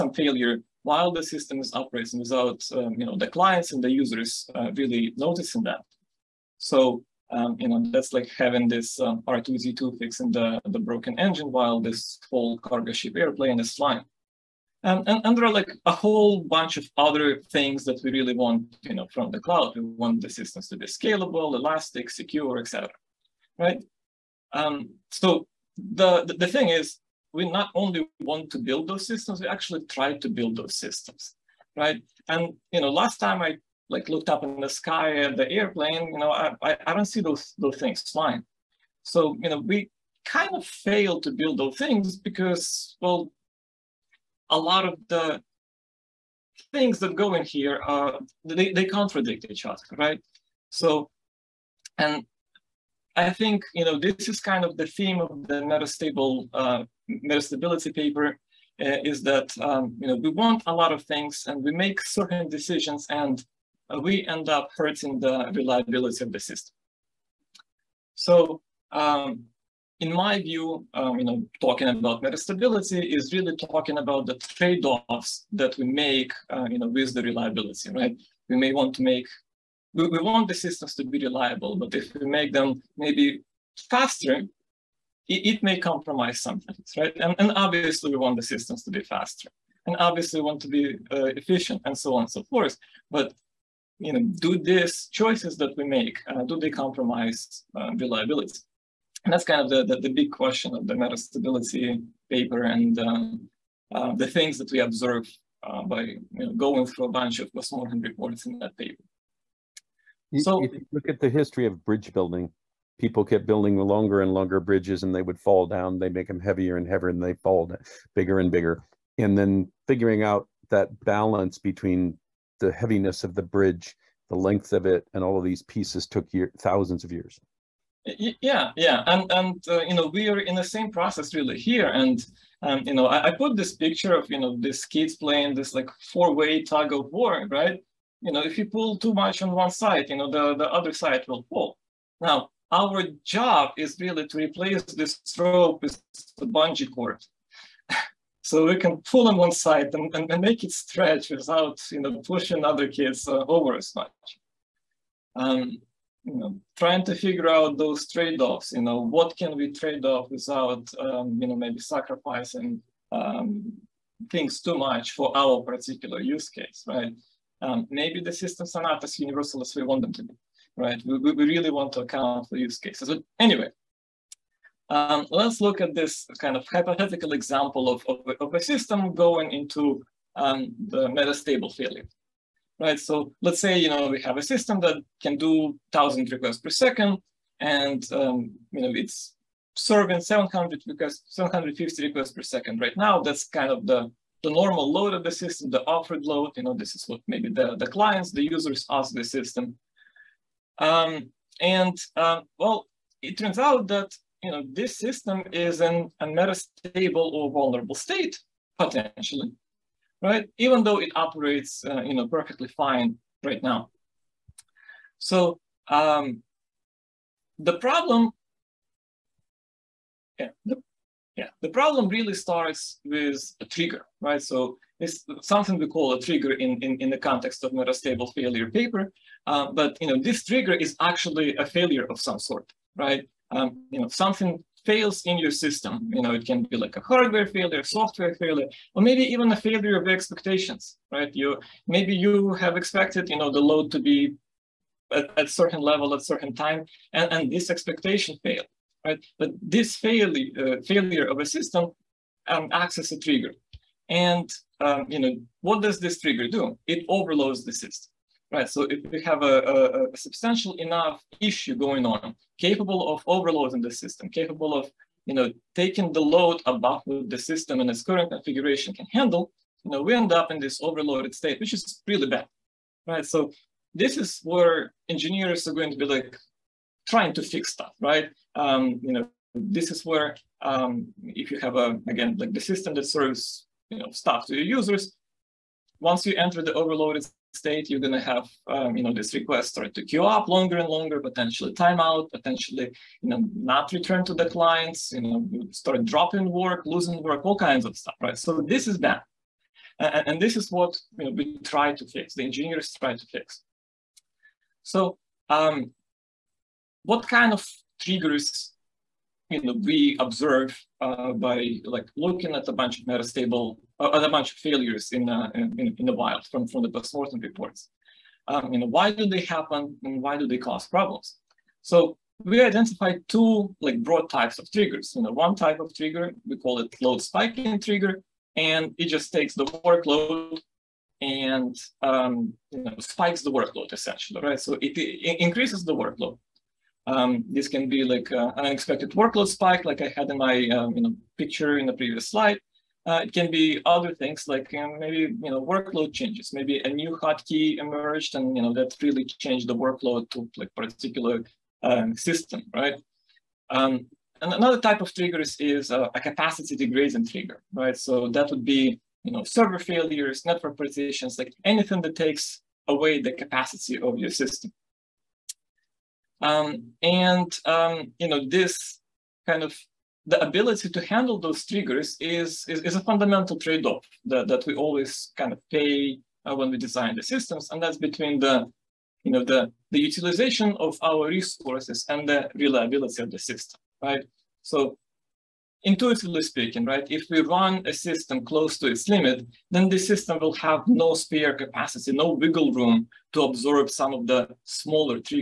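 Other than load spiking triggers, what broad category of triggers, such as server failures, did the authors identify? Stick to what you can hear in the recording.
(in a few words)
capacity degrading trigger.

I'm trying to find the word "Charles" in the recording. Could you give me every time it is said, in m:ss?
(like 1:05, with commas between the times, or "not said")
not said.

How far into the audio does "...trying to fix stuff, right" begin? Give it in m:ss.
4:37.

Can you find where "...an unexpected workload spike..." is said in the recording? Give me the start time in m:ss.
5:38.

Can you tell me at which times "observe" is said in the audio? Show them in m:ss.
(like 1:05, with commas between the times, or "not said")
1:44, 5:10.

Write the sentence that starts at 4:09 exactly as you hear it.
But this fail, uh, failure of a system um, acts as a trigger.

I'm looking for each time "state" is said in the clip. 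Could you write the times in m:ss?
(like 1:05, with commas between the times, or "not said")
3:27, 4:31, 4:47.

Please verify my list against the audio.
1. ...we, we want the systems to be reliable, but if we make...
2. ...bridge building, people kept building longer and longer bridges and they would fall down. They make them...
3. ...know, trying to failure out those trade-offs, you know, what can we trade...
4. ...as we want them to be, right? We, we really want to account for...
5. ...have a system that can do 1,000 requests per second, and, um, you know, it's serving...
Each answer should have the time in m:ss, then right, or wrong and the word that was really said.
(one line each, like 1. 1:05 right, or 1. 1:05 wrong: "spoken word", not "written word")
1. 1:19 right
2. 1:51 right
3. 2:36 wrong: "figure", not "failure"
4. 2:49 right
5. 3:04 right.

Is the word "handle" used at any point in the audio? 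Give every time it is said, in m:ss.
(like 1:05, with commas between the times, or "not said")
4:29, 6:11.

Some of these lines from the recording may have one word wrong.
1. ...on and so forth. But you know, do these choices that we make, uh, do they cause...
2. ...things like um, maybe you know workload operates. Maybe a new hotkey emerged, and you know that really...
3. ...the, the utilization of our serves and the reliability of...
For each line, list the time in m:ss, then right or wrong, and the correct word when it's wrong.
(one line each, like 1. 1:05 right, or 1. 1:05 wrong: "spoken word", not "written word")
1. 1:32 wrong: "compromise", not "cause"
2. 5:44 wrong: "changes", not "operates"
3. 6:19 wrong: "resources", not "serves".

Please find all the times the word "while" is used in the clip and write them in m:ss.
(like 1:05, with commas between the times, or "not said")
0:00, 0:11.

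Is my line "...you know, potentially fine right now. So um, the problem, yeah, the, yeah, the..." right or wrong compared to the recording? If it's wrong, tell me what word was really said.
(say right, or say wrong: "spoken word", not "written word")
wrong: "perfectly", not "potentially".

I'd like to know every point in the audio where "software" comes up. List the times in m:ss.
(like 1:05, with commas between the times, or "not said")
3:57.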